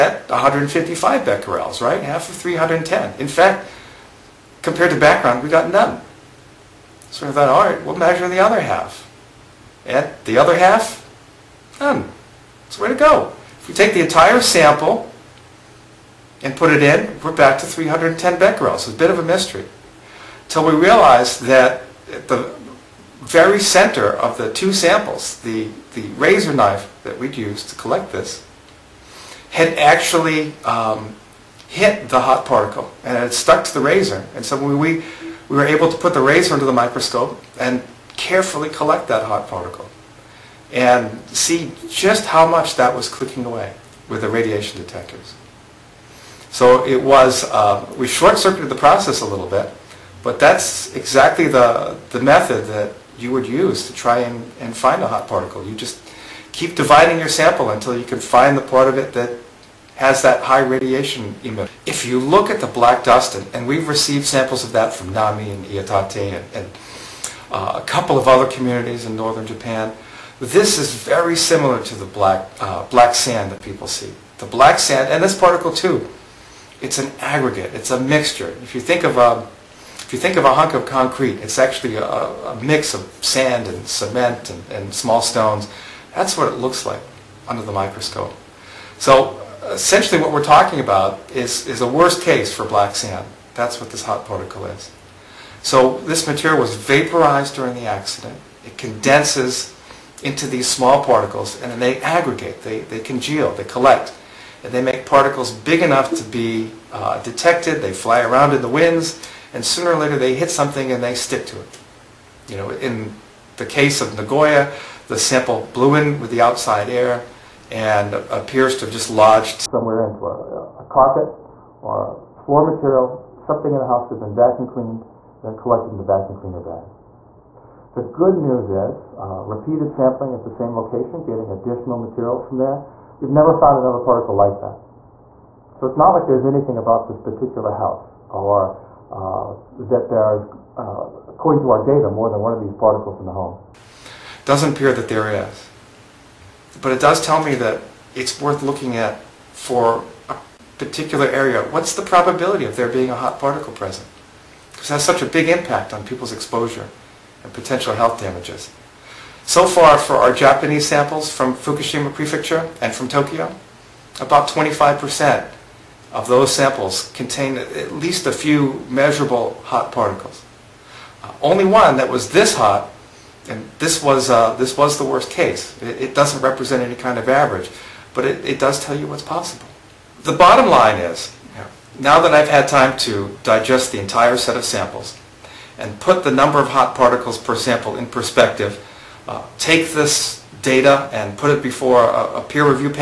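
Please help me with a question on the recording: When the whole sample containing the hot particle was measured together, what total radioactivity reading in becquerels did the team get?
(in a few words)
310 becquerels.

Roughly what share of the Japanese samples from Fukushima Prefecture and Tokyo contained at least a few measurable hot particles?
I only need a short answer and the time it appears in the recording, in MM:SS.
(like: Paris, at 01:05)
25%, at 02:44.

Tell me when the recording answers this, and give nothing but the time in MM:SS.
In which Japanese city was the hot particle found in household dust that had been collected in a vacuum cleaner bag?
01:54.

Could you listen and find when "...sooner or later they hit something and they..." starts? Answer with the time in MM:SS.
01:49.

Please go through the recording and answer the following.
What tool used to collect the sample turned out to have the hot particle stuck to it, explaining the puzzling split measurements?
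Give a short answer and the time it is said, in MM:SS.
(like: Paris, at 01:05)
razor knife, at 00:26.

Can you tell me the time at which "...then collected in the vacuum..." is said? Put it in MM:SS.
02:05.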